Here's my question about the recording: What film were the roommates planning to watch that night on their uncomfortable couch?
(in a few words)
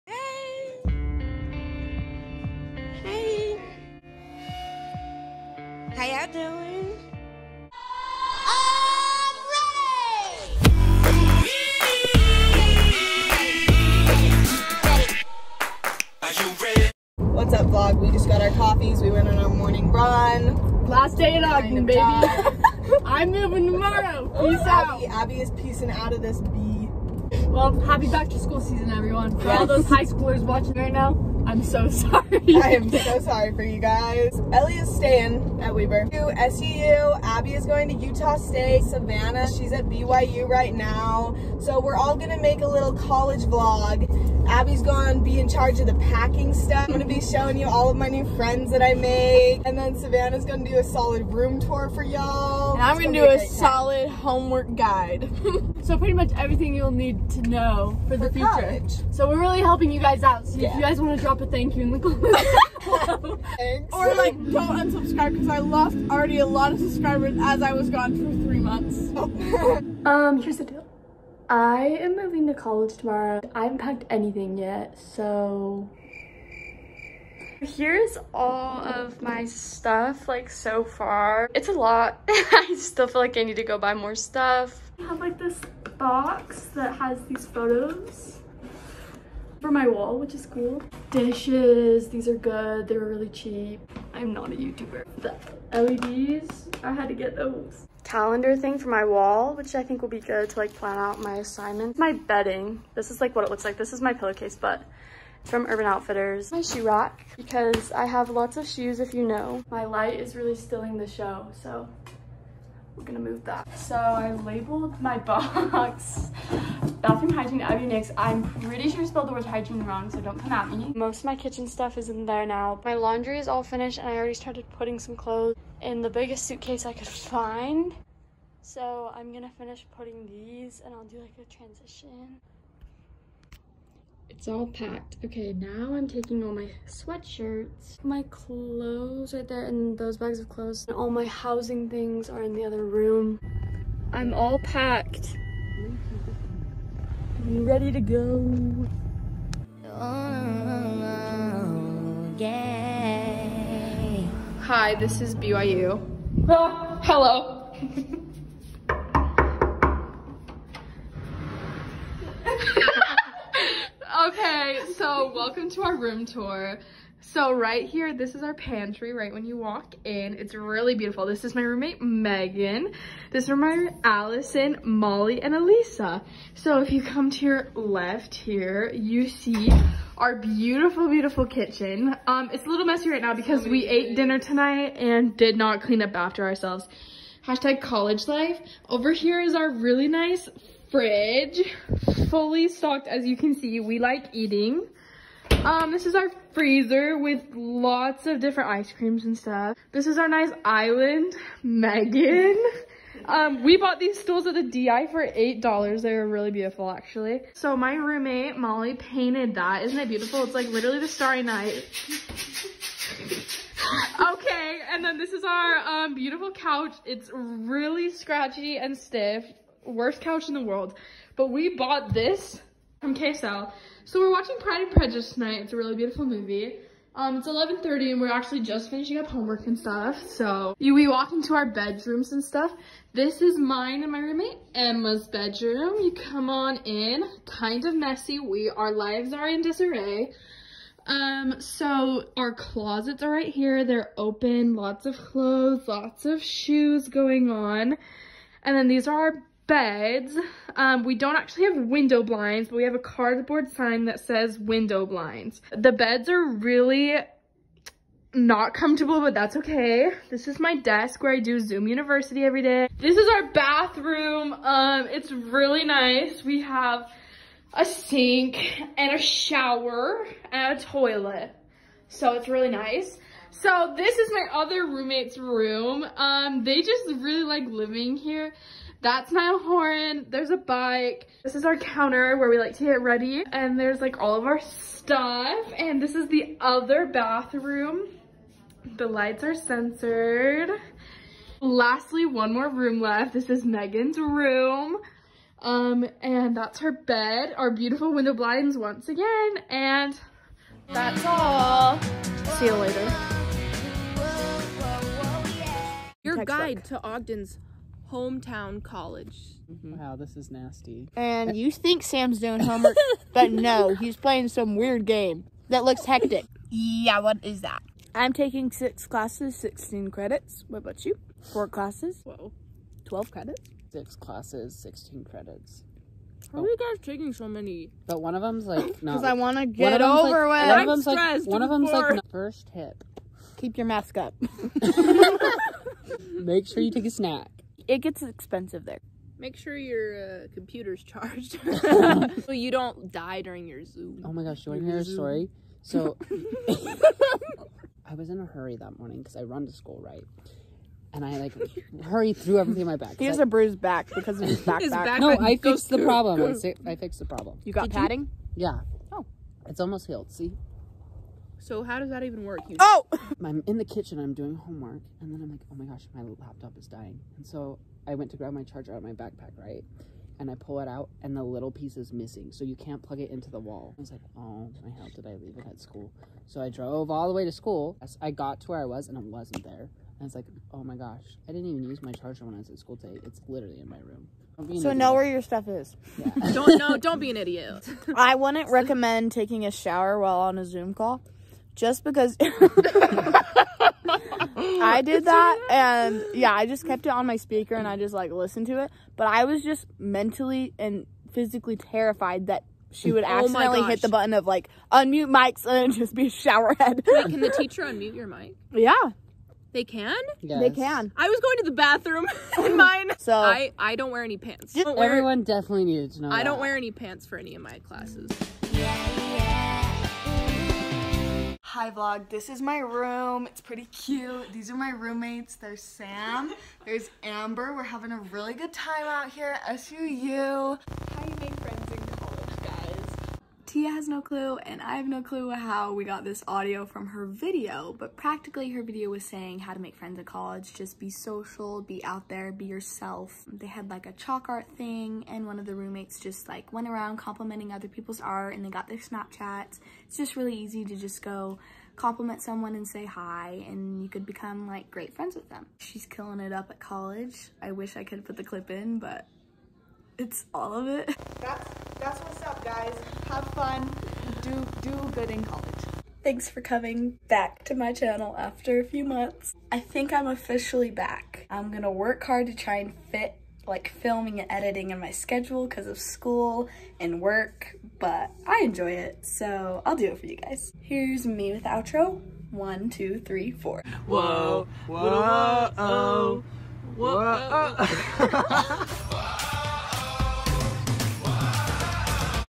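Pride and Prejudice.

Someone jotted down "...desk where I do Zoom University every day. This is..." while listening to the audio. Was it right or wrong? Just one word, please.
right.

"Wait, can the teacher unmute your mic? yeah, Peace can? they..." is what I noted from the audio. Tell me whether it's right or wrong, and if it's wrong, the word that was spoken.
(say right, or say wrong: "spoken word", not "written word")
wrong: "They", not "Peace".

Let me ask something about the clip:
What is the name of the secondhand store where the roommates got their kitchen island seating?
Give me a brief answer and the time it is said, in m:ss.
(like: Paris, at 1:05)
DI, at 3:24.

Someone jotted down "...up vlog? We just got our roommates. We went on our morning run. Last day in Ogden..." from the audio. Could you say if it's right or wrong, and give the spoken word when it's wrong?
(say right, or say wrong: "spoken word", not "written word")
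wrong: "coffees", not "roommates".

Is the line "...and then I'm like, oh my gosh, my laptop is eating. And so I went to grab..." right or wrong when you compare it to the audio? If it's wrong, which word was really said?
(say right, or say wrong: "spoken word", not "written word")
wrong: "dying", not "eating".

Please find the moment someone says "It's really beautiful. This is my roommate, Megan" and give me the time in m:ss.
2:50.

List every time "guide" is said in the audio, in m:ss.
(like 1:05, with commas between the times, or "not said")
0:54, 5:06.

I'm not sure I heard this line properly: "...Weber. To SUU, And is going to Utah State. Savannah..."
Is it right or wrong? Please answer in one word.
wrong.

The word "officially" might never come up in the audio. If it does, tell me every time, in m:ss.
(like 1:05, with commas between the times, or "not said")
7:50.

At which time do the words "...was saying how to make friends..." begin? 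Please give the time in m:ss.
7:19.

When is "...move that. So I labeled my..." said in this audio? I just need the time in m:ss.
1:53.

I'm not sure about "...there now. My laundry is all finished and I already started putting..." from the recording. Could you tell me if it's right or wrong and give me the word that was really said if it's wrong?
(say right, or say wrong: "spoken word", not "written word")
right.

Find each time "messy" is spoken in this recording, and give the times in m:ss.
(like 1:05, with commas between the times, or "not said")
3:02, 3:57.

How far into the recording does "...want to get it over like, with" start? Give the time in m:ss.
5:29.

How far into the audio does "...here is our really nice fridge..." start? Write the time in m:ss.
3:09.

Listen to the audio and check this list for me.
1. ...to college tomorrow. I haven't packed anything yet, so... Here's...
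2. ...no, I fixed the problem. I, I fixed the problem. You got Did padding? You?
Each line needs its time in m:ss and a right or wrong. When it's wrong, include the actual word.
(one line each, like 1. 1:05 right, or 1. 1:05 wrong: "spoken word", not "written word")
1. 1:12 right
2. 5:55 right.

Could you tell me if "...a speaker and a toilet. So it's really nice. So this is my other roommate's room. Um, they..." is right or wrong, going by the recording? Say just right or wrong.
wrong.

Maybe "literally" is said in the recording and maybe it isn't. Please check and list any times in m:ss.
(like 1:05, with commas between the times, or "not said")
3:30, 6:23.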